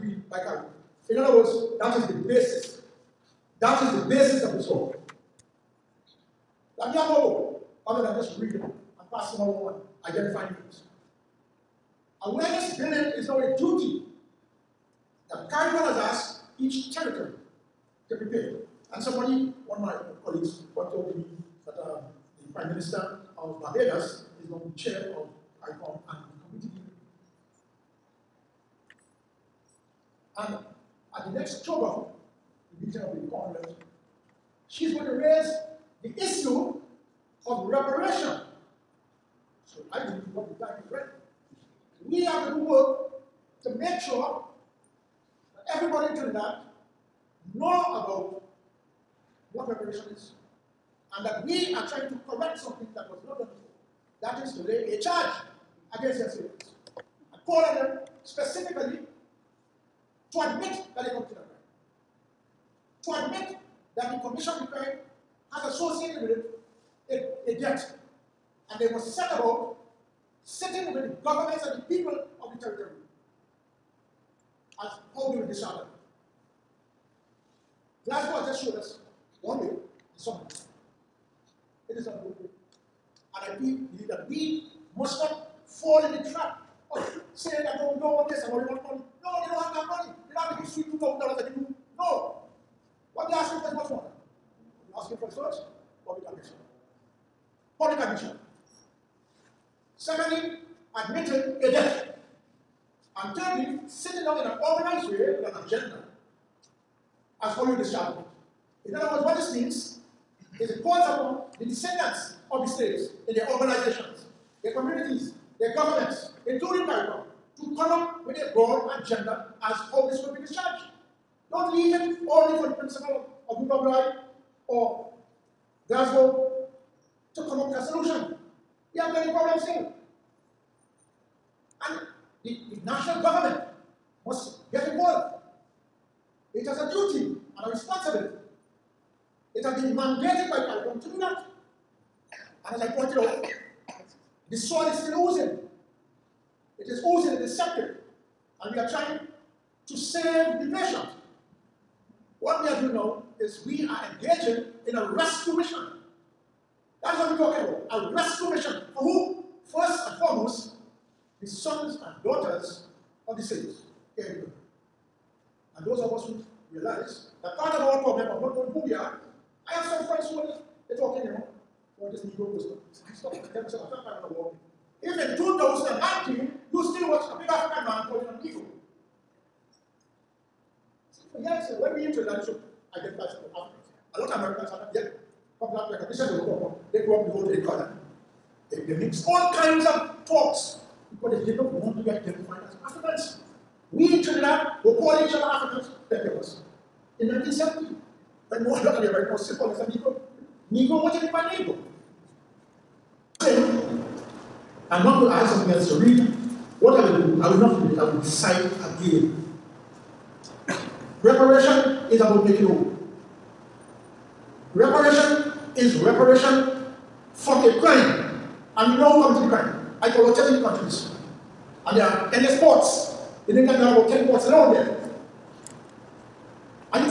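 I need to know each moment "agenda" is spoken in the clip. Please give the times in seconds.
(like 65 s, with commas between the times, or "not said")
105 s, 119 s.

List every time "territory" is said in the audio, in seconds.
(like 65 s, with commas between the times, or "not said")
16 s, 72 s.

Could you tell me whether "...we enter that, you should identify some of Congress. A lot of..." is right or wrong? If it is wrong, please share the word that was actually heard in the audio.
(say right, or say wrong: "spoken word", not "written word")
wrong: "Africans", not "Congress".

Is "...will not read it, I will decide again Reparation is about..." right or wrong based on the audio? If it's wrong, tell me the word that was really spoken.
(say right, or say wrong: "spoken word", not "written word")
right.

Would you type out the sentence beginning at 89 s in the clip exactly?
No, they don't have that money not that you sweep two thousand dollars and you do.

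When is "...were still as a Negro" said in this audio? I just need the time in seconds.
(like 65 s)
199 s.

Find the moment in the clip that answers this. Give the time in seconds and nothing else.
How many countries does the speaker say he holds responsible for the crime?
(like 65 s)
220 s.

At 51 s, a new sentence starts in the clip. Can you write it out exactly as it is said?
and that we are trying to correct something that was not done before.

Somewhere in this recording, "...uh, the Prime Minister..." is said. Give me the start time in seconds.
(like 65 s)
21 s.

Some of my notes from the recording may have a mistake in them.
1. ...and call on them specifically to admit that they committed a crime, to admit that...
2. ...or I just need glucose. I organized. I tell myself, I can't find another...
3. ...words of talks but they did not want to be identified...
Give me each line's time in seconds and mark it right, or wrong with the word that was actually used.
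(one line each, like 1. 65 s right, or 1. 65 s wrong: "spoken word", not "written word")
1. 57 s right
2. 172 s wrong: "stopped", not "organized"
3. 189 s wrong: "kinds", not "words".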